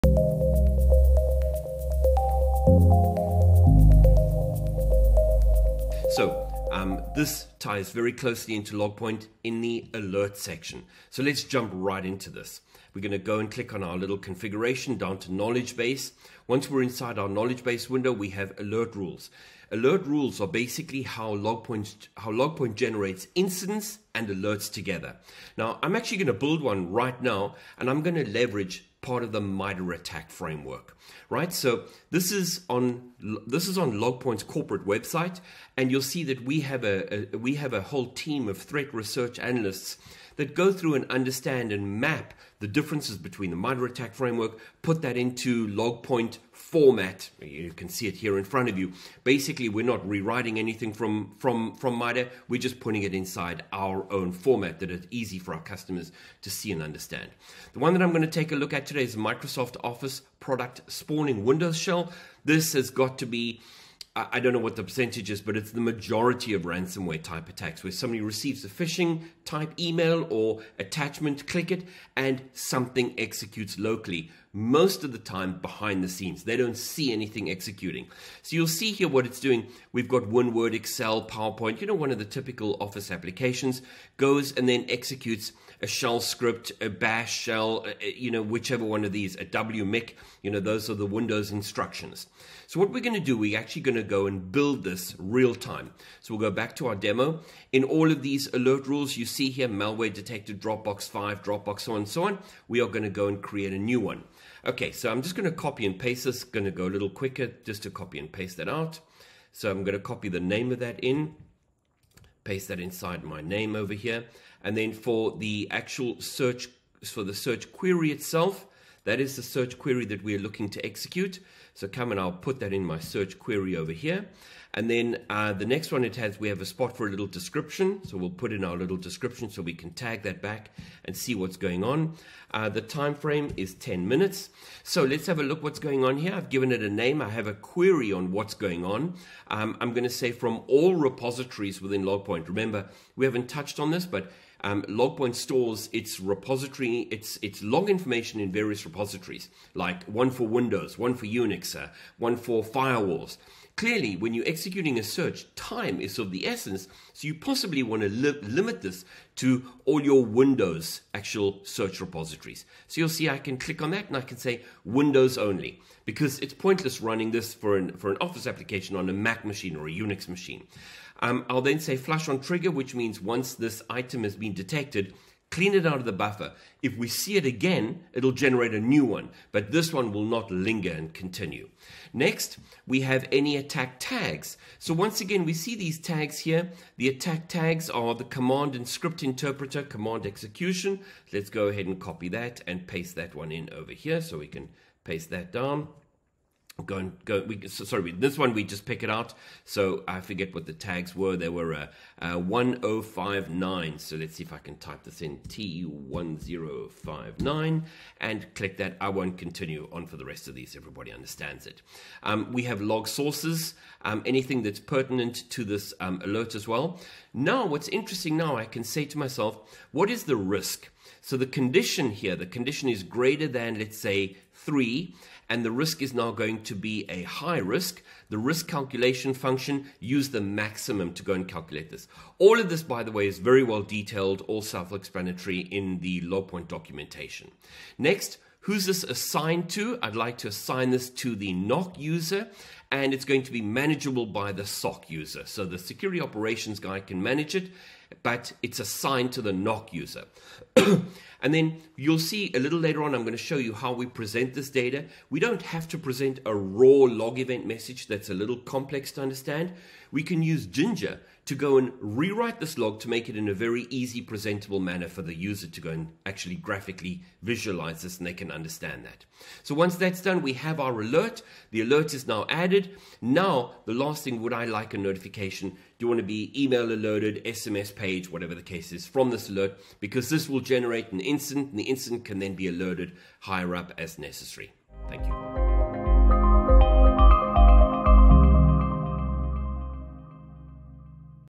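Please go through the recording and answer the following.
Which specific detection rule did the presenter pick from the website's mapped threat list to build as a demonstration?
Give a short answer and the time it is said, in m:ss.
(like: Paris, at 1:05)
Microsoft Office product spawning Windows shell, at 0:59.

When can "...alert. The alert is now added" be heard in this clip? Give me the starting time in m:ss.
4:31.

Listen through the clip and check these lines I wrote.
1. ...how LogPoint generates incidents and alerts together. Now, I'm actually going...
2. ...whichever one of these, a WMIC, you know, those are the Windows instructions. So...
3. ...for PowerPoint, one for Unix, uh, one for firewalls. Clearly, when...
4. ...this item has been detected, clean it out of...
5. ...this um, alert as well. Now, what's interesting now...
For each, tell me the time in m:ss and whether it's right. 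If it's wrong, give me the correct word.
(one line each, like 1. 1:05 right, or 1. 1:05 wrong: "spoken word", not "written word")
1. 0:22 right
2. 1:28 right
3. 2:30 wrong: "Windows", not "PowerPoint"
4. 2:53 right
5. 3:35 right.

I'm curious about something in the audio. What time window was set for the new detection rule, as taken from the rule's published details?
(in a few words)
10 minutes.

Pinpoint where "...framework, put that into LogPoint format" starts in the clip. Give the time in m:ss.
0:44.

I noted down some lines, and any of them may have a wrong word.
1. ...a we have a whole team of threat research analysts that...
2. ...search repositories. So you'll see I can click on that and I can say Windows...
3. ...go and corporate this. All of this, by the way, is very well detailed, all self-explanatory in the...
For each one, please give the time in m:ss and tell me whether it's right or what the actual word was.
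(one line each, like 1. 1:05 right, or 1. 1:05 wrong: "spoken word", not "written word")
1. 0:37 right
2. 2:41 right
3. 3:51 wrong: "calculate", not "corporate".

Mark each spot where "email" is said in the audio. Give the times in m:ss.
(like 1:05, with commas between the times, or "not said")
1:09, 4:36.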